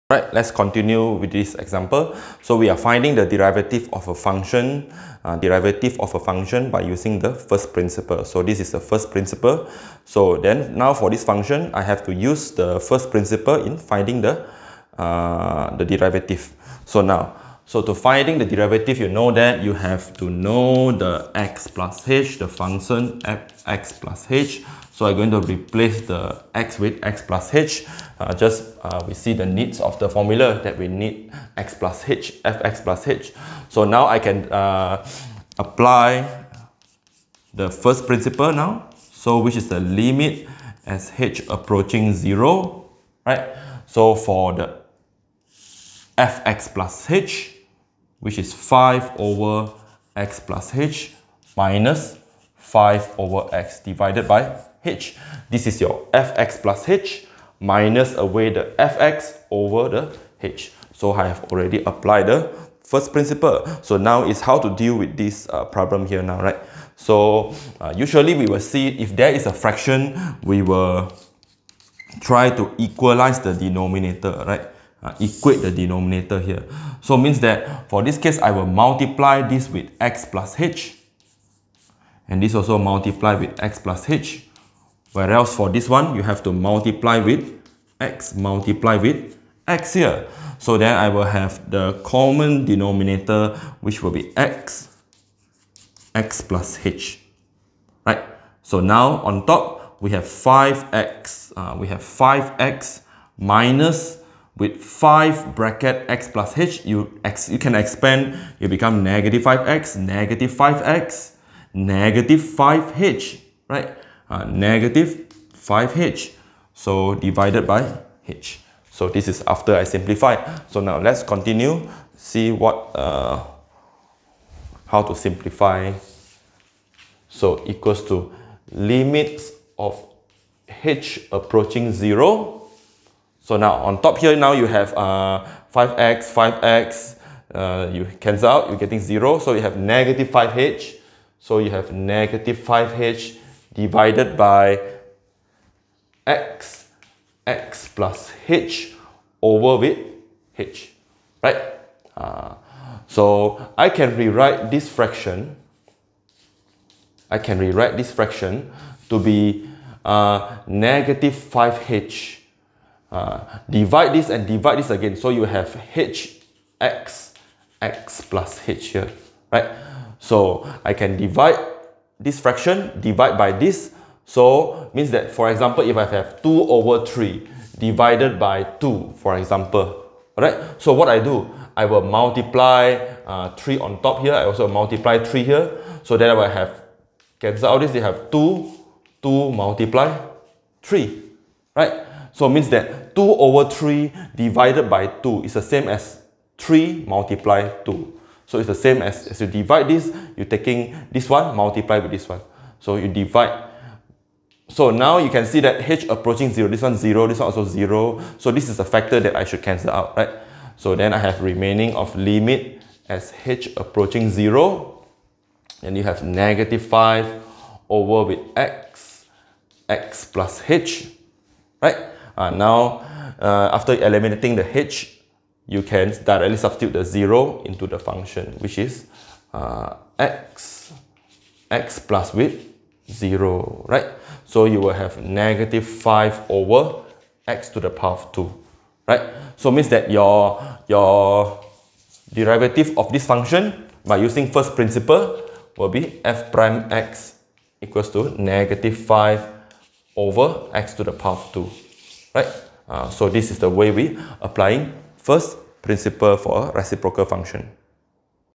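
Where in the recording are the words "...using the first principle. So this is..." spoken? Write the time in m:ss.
0:06.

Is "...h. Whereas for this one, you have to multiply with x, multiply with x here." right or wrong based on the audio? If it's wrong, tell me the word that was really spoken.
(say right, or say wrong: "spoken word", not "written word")
right.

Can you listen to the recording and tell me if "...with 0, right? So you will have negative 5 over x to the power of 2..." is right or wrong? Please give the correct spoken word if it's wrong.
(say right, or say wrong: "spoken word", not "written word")
right.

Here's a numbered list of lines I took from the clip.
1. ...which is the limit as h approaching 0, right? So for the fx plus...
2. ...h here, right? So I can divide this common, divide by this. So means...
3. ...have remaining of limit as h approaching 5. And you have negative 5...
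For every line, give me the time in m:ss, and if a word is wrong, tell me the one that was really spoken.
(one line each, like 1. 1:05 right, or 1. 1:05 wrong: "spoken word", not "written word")
1. 0:39 right
2. 2:48 wrong: "fraction", not "common"
3. 3:31 wrong: "0", not "5".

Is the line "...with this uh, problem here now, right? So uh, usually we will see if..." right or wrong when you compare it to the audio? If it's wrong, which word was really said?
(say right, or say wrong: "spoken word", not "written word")
right.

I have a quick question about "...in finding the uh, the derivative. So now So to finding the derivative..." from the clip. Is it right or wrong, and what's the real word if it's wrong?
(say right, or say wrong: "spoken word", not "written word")
right.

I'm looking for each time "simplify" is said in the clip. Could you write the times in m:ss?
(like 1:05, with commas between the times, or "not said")
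1:59, 2:05.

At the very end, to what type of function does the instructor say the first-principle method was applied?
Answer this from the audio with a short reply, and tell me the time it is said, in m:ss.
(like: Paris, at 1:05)
reciprocal function, at 4:16.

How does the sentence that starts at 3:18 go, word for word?
So it's the same as, as you divide this, you're taking this one, multiply with this one.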